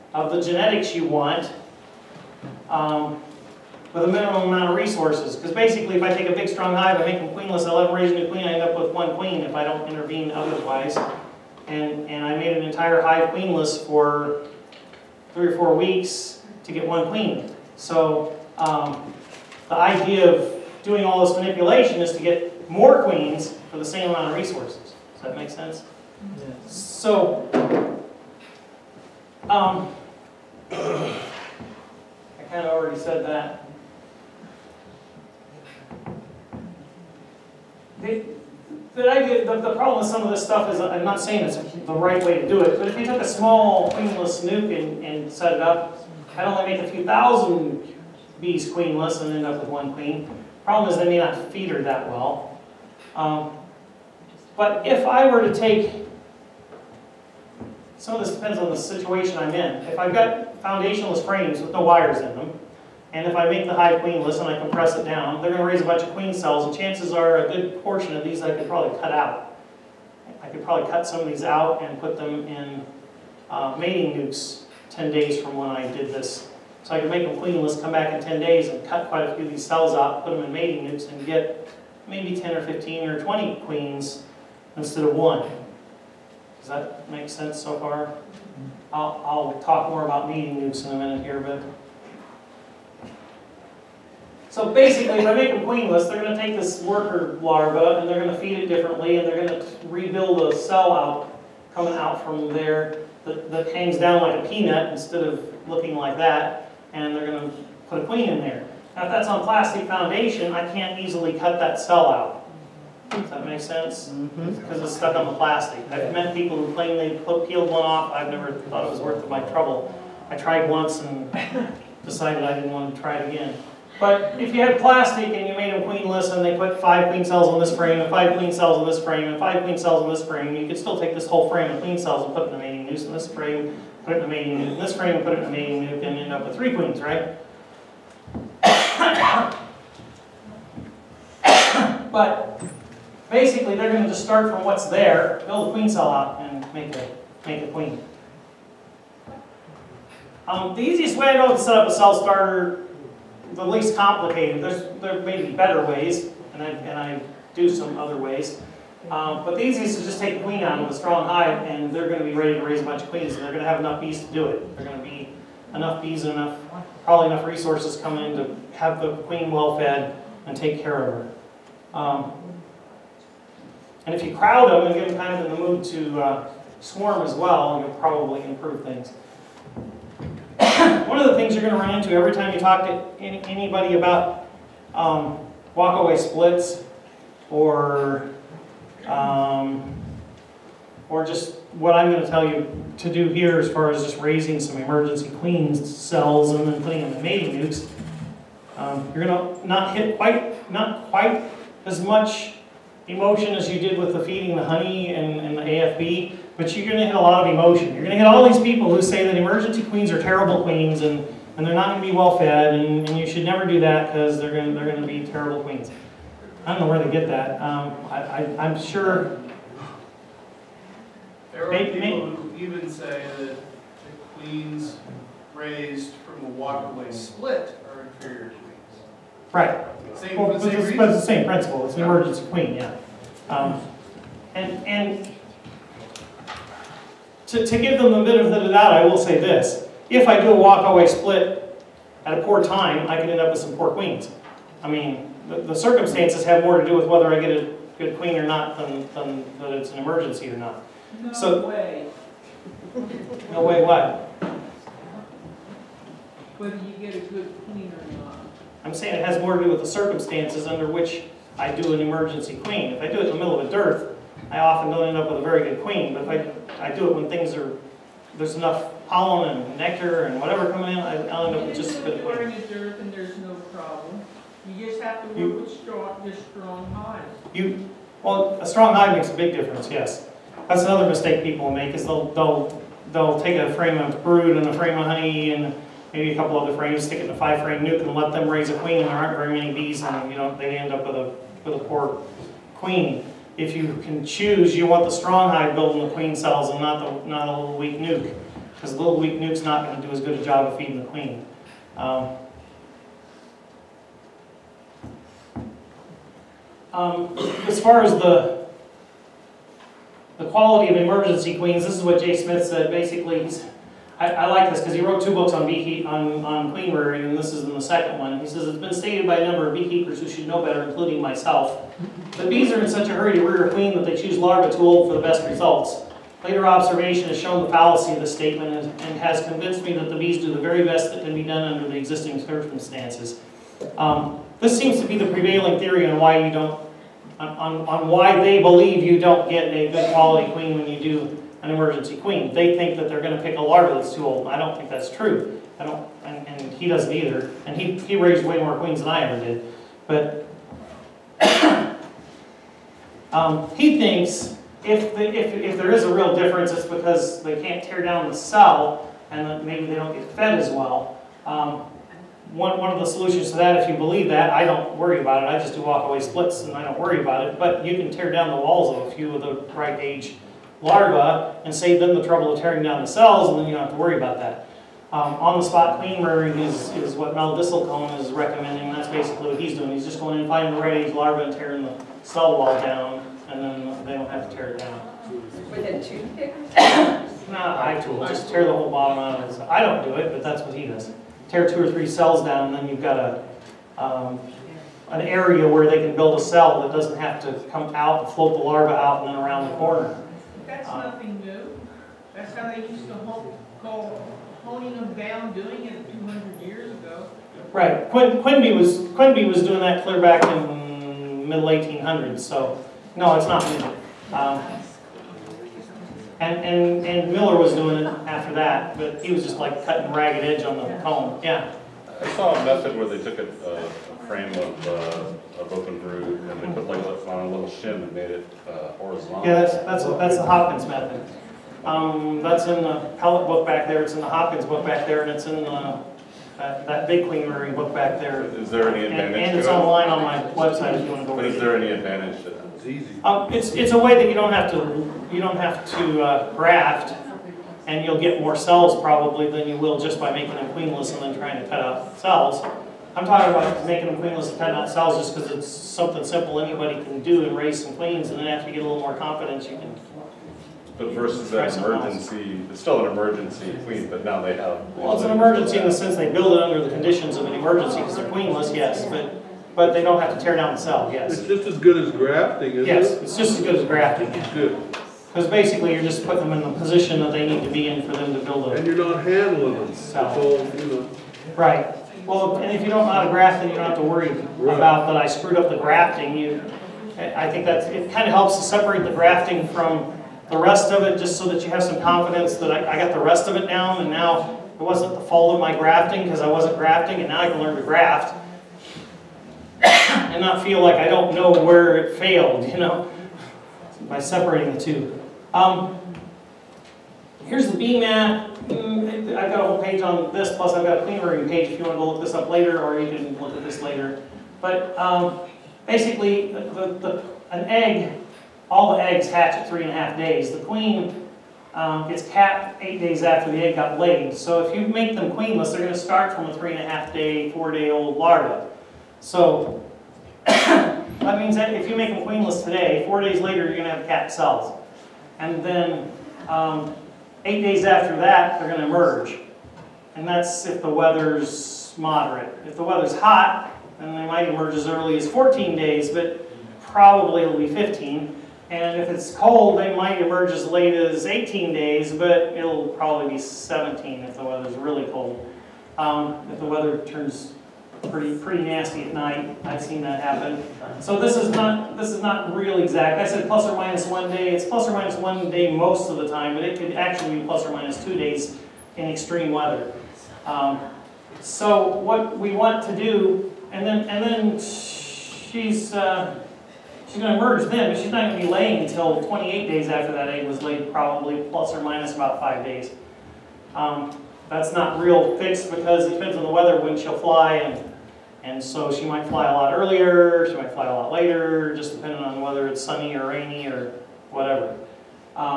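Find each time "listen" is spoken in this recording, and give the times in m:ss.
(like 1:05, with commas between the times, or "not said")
not said.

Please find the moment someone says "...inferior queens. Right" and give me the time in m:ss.
3:48.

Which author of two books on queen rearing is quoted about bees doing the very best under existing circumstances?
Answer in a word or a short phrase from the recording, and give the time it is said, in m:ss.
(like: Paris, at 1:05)
Jay Smith, at 5:12.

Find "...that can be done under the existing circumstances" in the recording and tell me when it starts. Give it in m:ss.
5:31.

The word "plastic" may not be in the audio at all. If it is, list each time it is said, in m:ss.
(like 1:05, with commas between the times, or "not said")
1:49, 1:55, 2:04.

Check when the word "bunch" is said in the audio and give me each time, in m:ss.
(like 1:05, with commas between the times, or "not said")
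1:05, 2:42.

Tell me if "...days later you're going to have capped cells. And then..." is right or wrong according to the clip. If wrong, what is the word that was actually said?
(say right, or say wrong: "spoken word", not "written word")
right.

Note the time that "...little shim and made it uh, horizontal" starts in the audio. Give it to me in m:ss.
7:07.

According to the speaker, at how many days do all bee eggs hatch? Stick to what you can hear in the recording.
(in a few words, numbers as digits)
3.5 days.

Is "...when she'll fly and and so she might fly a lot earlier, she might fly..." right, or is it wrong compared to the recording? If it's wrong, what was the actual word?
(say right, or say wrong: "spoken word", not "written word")
right.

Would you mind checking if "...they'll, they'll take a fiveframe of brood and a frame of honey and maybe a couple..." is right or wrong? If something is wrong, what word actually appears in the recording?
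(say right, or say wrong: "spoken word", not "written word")
wrong: "frame", not "fiveframe".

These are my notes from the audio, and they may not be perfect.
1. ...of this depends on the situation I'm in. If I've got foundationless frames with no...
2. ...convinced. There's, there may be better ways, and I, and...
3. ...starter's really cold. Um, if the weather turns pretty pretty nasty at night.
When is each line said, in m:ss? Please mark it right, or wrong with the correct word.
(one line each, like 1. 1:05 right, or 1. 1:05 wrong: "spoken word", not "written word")
1. 0:58 right
2. 2:33 wrong: "complicated", not "convinced"
3. 9:14 wrong: "weather", not "starter".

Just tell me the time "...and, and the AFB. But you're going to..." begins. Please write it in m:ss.
3:25.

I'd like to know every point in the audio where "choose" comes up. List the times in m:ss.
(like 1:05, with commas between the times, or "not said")
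4:54, 5:24.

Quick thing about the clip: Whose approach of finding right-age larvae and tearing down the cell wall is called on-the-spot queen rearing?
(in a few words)
Mel Disselkoen.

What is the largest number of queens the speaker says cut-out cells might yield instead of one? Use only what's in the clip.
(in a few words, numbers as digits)
20.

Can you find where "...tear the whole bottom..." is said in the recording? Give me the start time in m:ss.
6:28.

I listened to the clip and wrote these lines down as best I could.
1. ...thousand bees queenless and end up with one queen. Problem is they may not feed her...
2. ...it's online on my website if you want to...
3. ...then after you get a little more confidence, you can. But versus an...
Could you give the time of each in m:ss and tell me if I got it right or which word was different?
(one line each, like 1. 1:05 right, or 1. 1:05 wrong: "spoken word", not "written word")
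1. 0:47 right
2. 7:19 right
3. 7:38 right.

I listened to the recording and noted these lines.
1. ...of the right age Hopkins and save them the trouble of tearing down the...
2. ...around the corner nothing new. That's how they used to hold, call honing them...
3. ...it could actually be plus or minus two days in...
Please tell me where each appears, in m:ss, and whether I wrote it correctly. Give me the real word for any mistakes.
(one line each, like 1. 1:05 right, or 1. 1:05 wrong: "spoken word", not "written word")
1. 6:09 wrong: "Larva", not "Hopkins"
2. 6:39 right
3. 9:26 right.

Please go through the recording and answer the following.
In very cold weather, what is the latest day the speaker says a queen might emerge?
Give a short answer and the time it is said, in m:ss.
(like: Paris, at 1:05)
18 days, at 9:11.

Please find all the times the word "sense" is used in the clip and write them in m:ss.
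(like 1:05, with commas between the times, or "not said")
0:25, 1:27, 1:53, 7:45.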